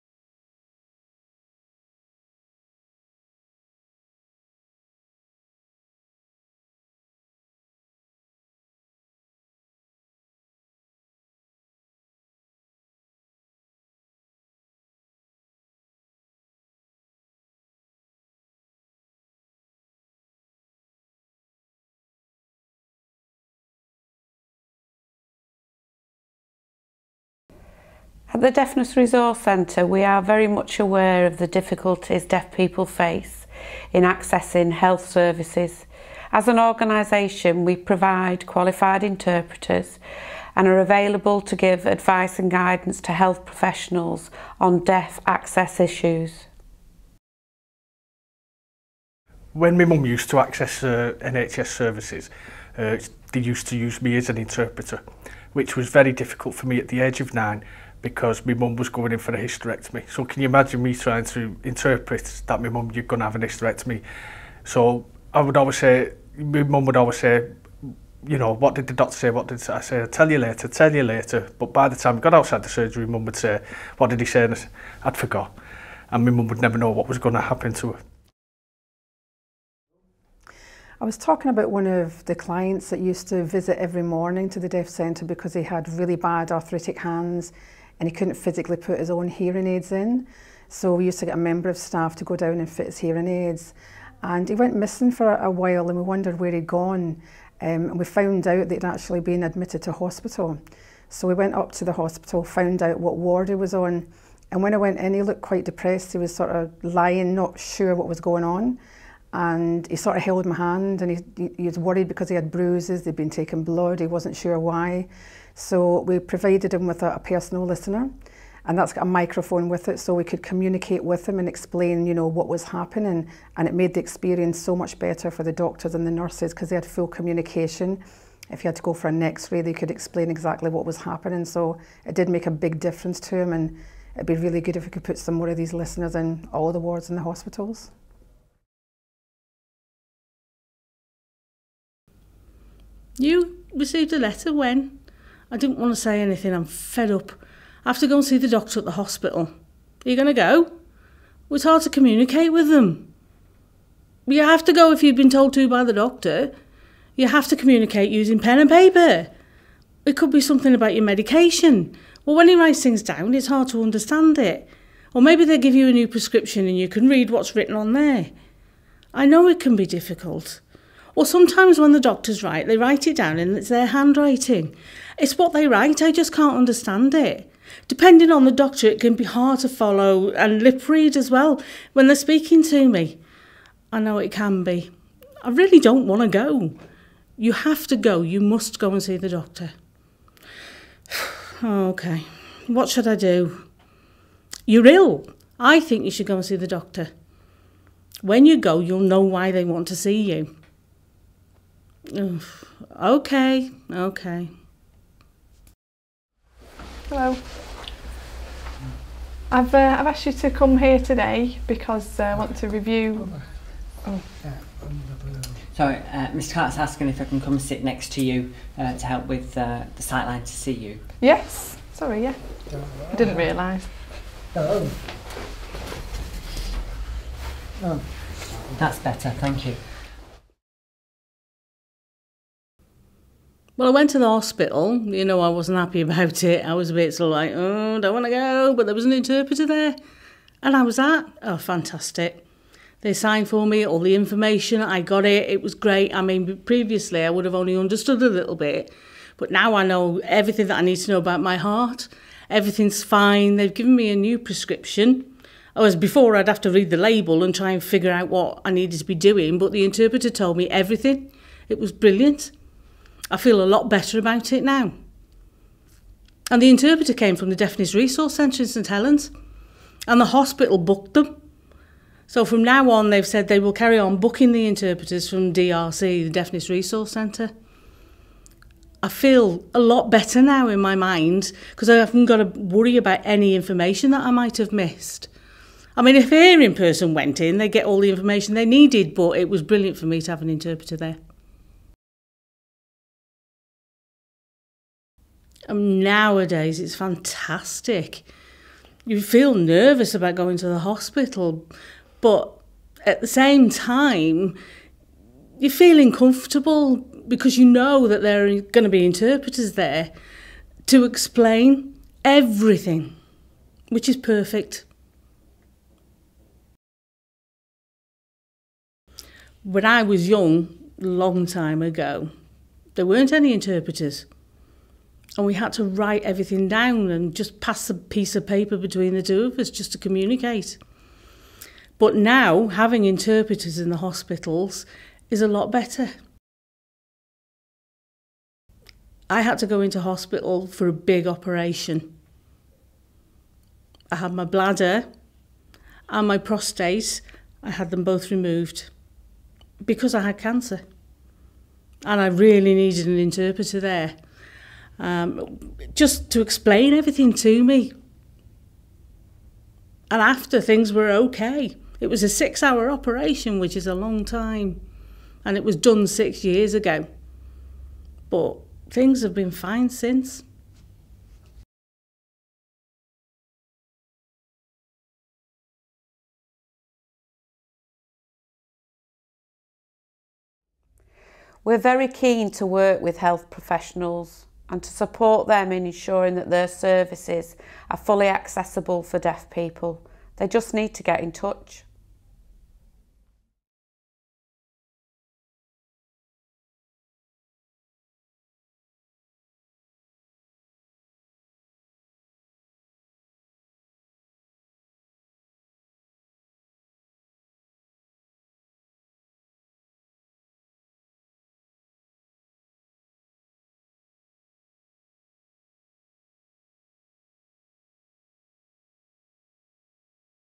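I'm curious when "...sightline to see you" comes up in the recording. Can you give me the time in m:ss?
3:40.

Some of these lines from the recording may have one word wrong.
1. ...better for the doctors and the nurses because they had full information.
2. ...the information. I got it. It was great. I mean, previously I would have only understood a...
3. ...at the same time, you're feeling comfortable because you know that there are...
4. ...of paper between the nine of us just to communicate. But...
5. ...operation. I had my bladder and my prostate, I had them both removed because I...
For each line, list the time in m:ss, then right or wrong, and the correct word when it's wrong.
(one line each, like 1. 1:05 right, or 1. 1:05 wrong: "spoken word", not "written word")
1. 2:04 wrong: "communication", not "information"
2. 4:03 right
3. 5:03 right
4. 5:28 wrong: "two", not "nine"
5. 5:41 right.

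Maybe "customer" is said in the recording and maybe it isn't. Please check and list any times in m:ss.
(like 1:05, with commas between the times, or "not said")
not said.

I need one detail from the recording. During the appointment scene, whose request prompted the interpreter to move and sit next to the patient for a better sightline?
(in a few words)
Mr. Clark.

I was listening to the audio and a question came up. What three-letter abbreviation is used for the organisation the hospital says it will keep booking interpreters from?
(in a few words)
DRC.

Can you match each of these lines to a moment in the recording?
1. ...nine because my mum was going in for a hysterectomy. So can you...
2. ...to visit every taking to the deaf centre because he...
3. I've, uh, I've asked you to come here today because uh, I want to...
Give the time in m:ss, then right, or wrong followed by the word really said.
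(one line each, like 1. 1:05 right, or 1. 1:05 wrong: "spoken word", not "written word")
1. 0:57 right
2. 1:23 wrong: "morning", not "taking"
3. 3:29 right.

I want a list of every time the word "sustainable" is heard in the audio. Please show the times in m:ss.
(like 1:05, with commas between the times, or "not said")
not said.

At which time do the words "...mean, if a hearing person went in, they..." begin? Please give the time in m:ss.
4:46.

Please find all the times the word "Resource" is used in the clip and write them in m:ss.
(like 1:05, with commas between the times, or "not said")
0:28, 4:27, 4:36.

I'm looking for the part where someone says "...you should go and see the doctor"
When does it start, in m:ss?
3:16.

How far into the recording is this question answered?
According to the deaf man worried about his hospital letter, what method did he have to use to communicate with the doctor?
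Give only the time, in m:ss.
2:38.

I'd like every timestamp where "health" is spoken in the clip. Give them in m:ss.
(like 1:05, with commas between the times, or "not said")
0:34, 0:43, 6:23.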